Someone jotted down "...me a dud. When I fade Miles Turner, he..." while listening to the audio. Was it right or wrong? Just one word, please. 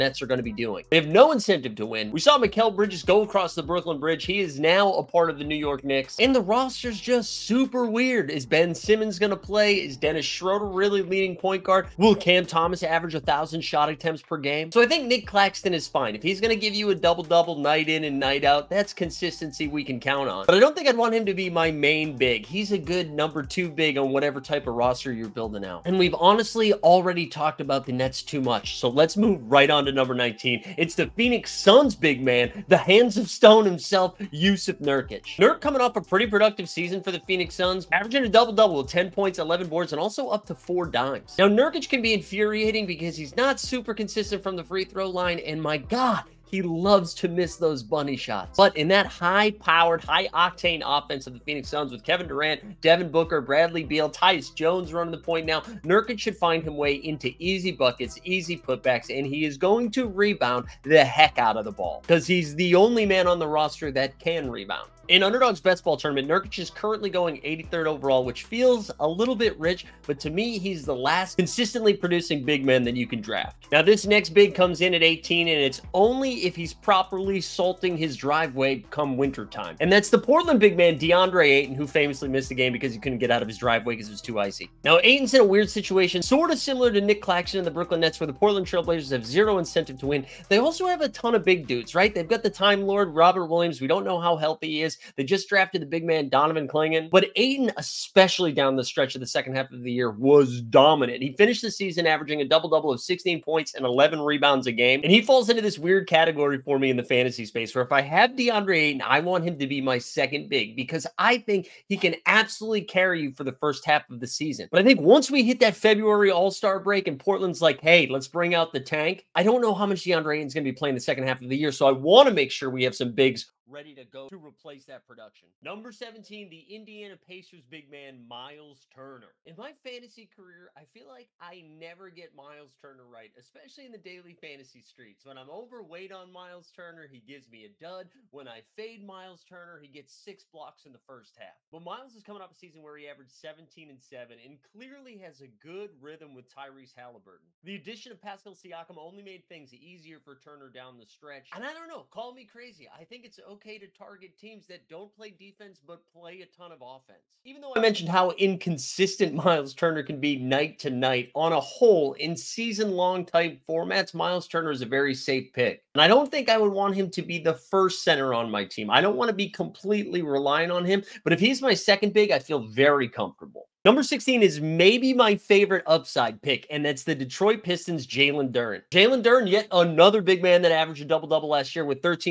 right.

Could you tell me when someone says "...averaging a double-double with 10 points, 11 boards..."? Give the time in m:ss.
0:37.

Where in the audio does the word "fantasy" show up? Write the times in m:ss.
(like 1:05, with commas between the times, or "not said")
1:47, 2:09, 2:14.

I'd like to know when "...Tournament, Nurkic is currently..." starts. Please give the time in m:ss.
1:05.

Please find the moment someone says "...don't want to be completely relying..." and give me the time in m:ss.
2:48.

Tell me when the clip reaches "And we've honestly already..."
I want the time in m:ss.
0:25.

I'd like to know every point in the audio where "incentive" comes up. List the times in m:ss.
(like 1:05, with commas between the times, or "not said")
0:01, 1:29.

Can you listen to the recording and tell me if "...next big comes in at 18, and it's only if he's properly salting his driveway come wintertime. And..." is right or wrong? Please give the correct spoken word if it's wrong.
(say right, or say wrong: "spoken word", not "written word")
right.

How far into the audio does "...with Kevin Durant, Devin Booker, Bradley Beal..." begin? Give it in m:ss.
0:51.